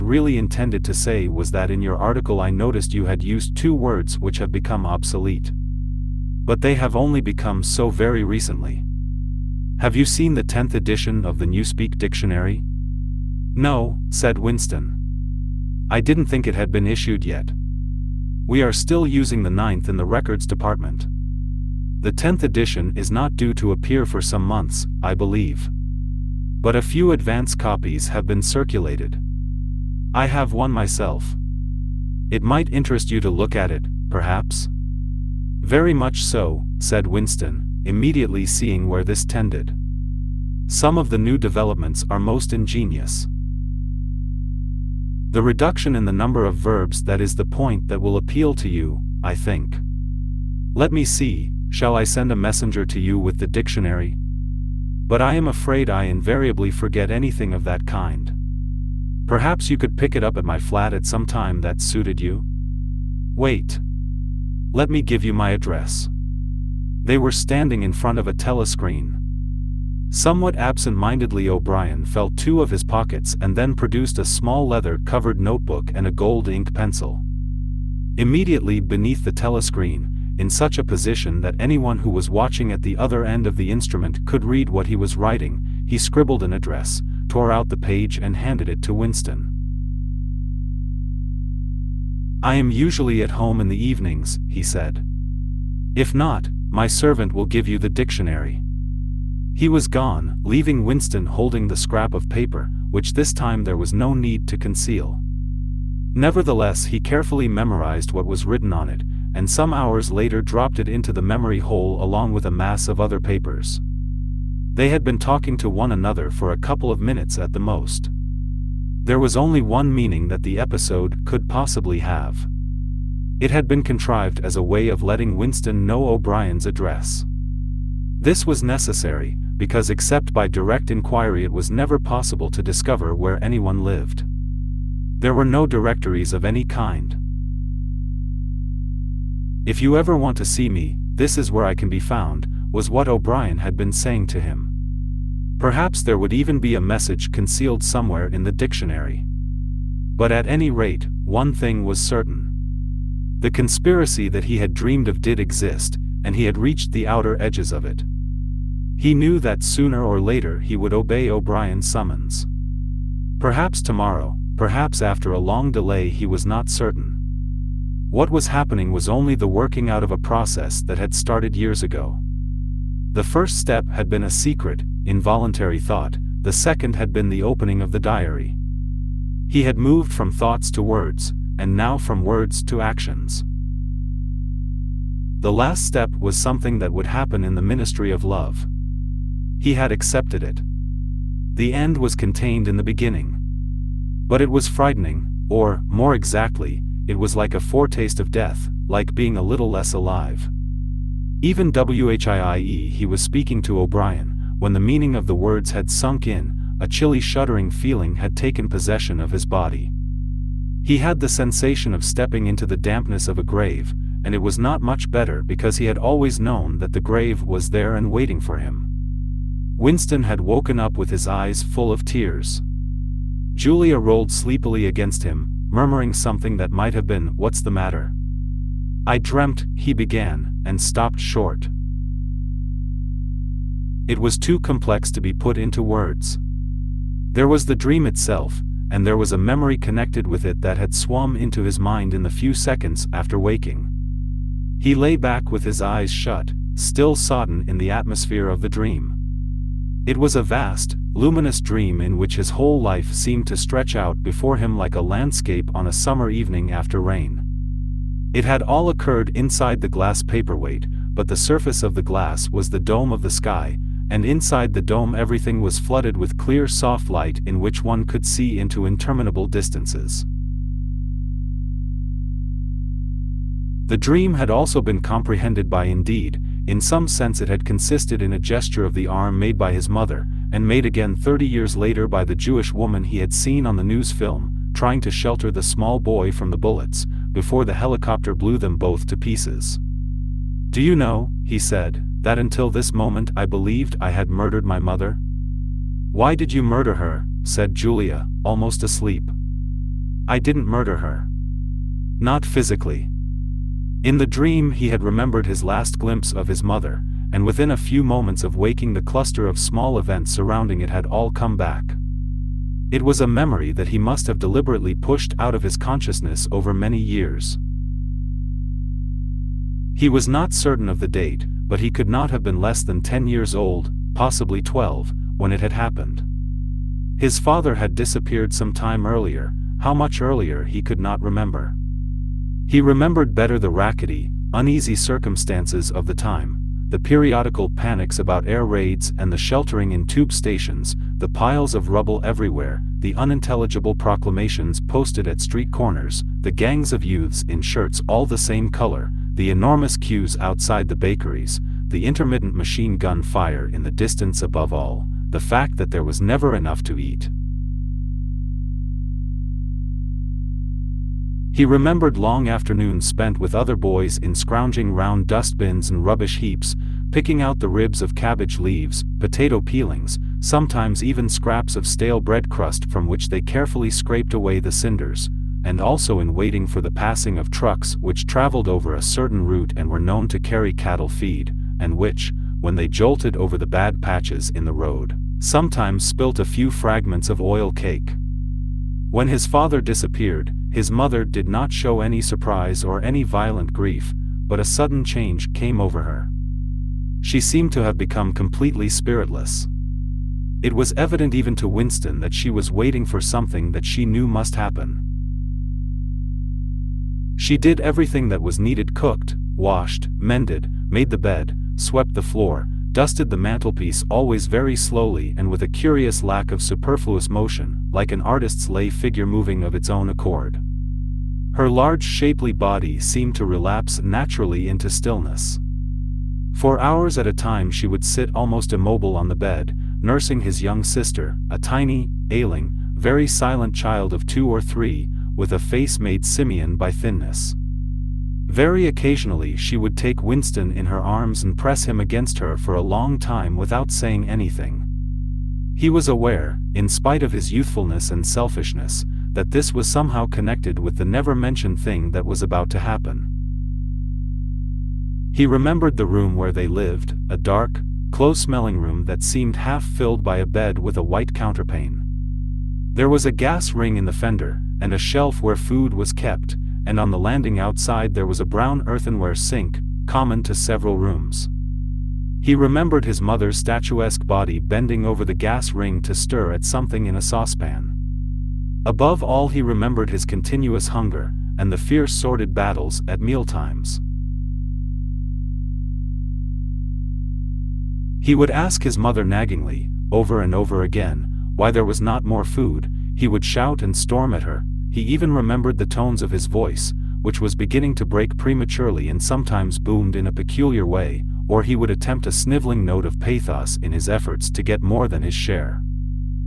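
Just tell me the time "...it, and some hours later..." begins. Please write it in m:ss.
1:48.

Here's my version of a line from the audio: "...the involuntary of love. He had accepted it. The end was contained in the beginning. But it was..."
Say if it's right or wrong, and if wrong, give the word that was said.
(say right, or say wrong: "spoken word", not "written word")
wrong: "ministry", not "involuntary".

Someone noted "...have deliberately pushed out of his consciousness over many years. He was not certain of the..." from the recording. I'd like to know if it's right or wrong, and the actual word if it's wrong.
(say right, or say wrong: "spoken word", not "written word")
right.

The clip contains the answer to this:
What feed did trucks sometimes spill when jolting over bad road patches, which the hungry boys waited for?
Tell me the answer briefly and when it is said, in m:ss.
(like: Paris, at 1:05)
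oil cake, at 6:27.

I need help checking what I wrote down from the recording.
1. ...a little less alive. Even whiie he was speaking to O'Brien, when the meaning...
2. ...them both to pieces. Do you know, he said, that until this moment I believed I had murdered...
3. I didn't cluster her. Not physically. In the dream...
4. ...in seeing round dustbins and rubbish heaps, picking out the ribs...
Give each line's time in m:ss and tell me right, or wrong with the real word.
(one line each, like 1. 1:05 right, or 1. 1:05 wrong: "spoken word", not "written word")
1. 3:19 right
2. 4:48 right
3. 5:00 wrong: "murder", not "cluster"
4. 6:04 wrong: "scrounging", not "seeing".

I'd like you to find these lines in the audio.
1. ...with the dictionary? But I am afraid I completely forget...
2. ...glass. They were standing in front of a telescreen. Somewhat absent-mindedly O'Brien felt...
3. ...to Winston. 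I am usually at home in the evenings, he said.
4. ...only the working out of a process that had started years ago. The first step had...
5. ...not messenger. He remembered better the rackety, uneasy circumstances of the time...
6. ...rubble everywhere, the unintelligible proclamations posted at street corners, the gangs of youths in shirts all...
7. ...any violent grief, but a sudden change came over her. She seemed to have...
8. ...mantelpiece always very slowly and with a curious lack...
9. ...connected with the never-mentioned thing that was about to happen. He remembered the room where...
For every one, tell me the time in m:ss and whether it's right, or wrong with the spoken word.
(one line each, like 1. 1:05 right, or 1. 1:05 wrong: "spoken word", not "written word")
1. 0:53 wrong: "invariably", not "completely"
2. 1:05 wrong: "address", not "glass"
3. 1:28 right
4. 2:49 right
5. 5:30 wrong: "remember", not "messenger"
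6. 5:41 right
7. 6:33 right
8. 6:53 right
9. 7:30 right.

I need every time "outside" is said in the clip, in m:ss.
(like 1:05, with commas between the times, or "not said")
5:50, 7:47.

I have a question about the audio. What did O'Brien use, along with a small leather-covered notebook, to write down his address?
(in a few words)
gold ink pencil.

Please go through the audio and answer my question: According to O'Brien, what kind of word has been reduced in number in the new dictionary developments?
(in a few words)
verbs.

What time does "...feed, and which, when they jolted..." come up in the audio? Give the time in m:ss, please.
6:21.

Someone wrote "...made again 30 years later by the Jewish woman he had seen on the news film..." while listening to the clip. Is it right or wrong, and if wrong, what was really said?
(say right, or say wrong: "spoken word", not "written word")
right.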